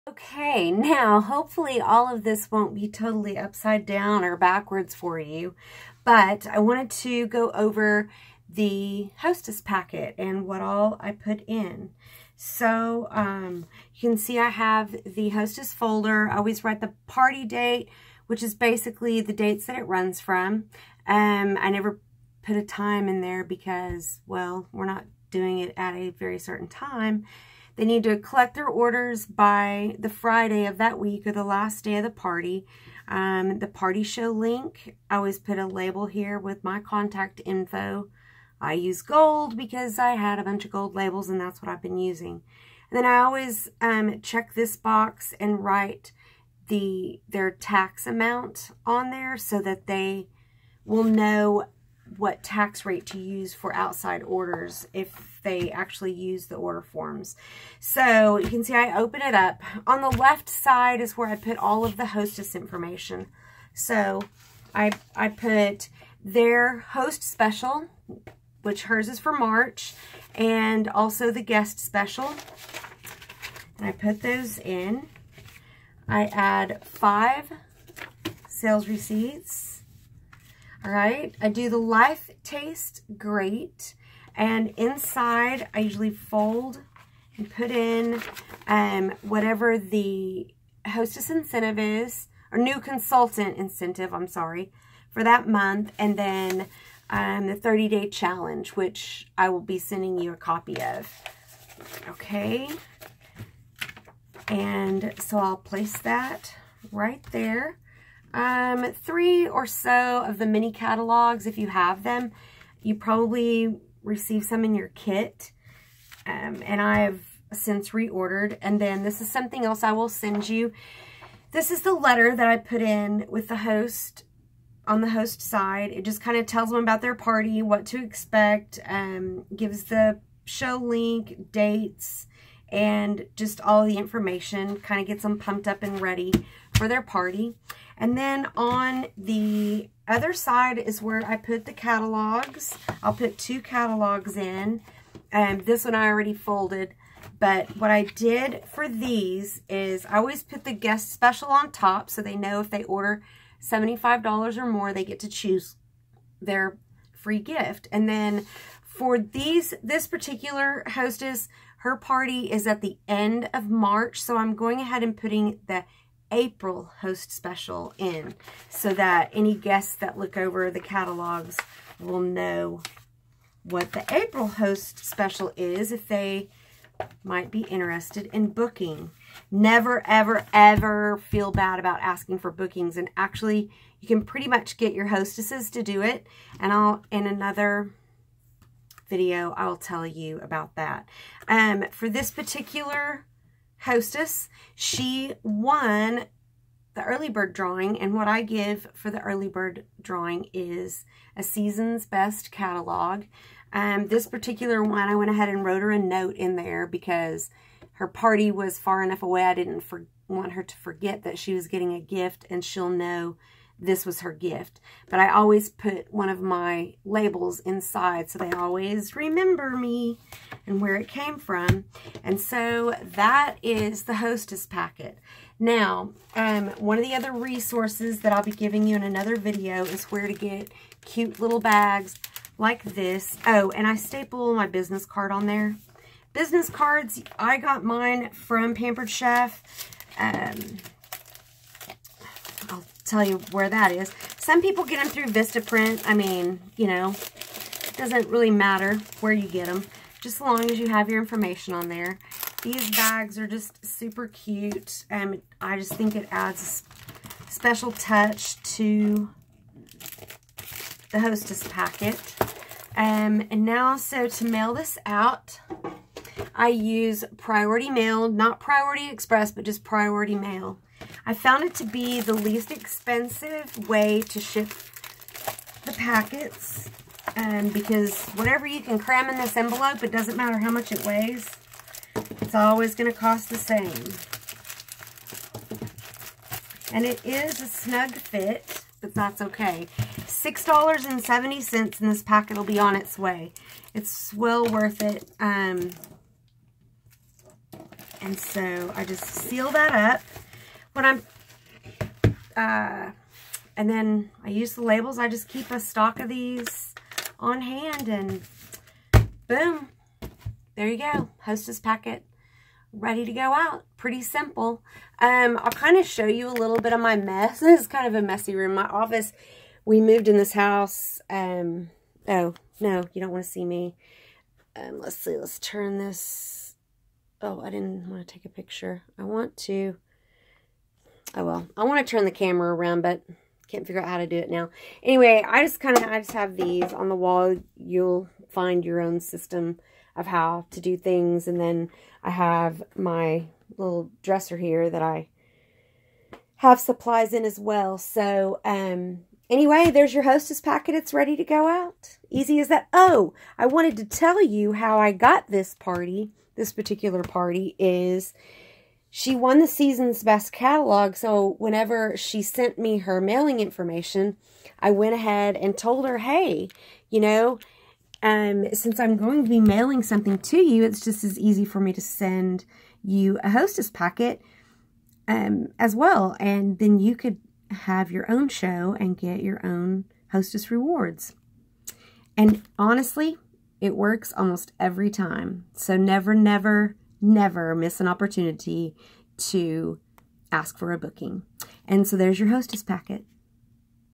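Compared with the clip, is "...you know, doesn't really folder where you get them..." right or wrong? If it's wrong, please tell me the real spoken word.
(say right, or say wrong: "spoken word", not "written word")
wrong: "matter", not "folder".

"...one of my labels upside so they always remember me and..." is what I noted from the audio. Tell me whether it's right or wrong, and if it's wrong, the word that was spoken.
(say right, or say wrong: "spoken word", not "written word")
wrong: "inside", not "upside".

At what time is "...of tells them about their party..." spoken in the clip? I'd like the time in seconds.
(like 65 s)
126 s.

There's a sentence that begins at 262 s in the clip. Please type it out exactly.
Um, and now, so to mail this out, I use Priority Mail, not Priority Express, but just Priority Mail.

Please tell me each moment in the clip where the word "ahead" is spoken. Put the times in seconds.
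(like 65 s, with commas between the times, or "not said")
164 s, 205 s, 365 s.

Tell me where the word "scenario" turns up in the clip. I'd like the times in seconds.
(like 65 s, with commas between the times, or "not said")
not said.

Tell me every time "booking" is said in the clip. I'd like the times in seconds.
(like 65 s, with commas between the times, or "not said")
178 s, 182 s, 390 s.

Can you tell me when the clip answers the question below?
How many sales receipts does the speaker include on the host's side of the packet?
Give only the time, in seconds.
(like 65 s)
76 s.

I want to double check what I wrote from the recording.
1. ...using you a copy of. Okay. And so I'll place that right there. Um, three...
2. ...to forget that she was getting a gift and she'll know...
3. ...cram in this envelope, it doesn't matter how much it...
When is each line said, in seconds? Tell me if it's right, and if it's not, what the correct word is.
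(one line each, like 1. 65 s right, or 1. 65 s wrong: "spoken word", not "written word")
1. 99 s wrong: "sending", not "using"
2. 210 s right
3. 278 s right.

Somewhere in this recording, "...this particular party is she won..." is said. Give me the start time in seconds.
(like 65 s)
356 s.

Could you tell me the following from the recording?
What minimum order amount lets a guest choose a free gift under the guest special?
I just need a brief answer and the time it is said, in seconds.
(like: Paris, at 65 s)
$75, at 153 s.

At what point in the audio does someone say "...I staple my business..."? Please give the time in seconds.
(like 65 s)
233 s.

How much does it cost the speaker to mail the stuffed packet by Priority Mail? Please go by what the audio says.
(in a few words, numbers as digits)
$6.70.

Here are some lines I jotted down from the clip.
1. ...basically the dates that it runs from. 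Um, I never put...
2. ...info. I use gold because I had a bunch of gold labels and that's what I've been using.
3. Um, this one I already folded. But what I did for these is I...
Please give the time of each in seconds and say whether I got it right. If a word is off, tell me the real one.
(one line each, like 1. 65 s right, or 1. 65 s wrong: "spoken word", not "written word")
1. 18 s right
2. 37 s right
3. 145 s right.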